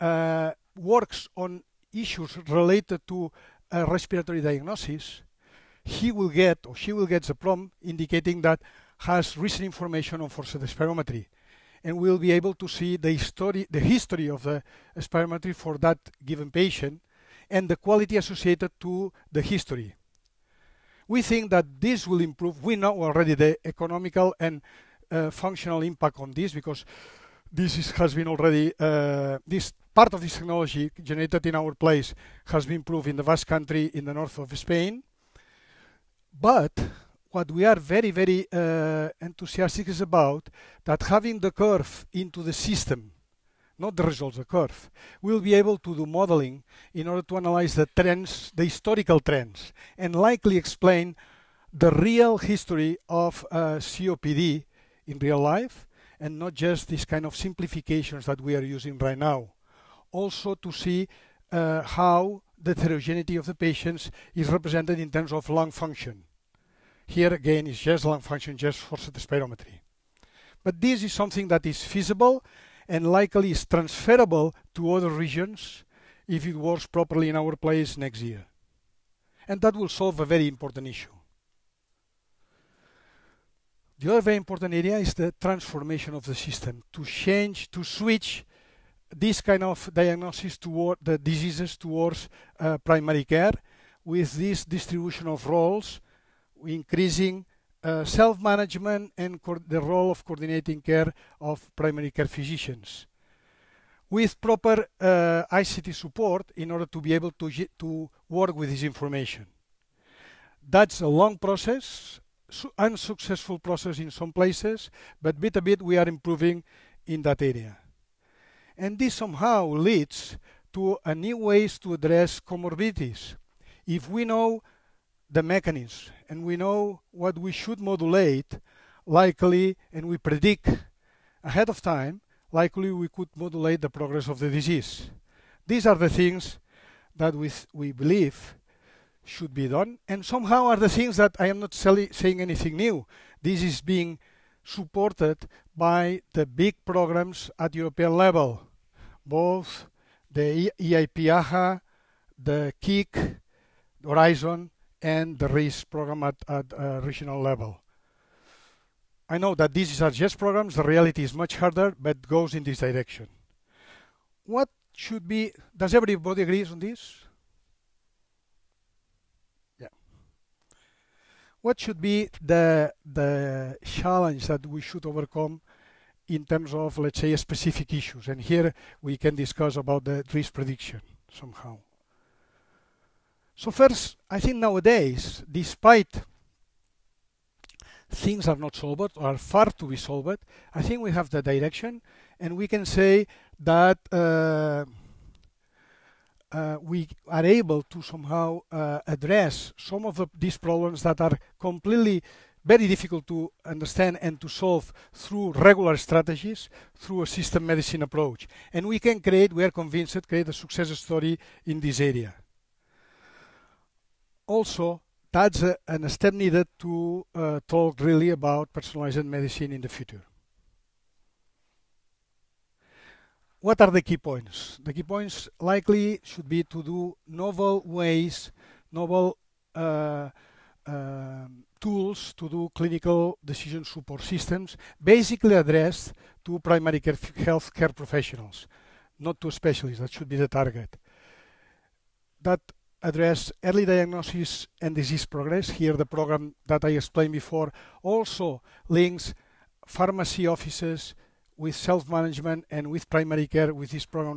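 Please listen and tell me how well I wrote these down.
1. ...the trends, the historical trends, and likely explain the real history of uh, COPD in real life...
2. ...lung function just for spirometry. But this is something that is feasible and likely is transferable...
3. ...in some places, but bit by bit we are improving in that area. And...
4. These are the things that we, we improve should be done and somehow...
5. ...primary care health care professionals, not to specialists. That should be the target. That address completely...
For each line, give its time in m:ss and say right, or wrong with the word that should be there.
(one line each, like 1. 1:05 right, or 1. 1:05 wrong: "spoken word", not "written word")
1. 0:47 right
2. 1:08 right
3. 1:53 right
4. 2:15 wrong: "believe", not "improve"
5. 3:56 wrong: "early", not "completely".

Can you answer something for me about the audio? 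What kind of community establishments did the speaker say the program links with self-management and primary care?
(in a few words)
Pharmacy offices.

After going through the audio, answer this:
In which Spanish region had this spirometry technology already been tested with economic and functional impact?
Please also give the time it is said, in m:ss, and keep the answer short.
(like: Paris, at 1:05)
Basque country, at 0:33.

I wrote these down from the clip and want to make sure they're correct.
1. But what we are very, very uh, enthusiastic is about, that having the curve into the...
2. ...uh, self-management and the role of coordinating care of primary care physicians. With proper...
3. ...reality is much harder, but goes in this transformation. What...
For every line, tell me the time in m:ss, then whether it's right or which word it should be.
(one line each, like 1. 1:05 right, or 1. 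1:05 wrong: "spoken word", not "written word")
1. 0:36 right
2. 1:37 right
3. 2:40 wrong: "direction", not "transformation".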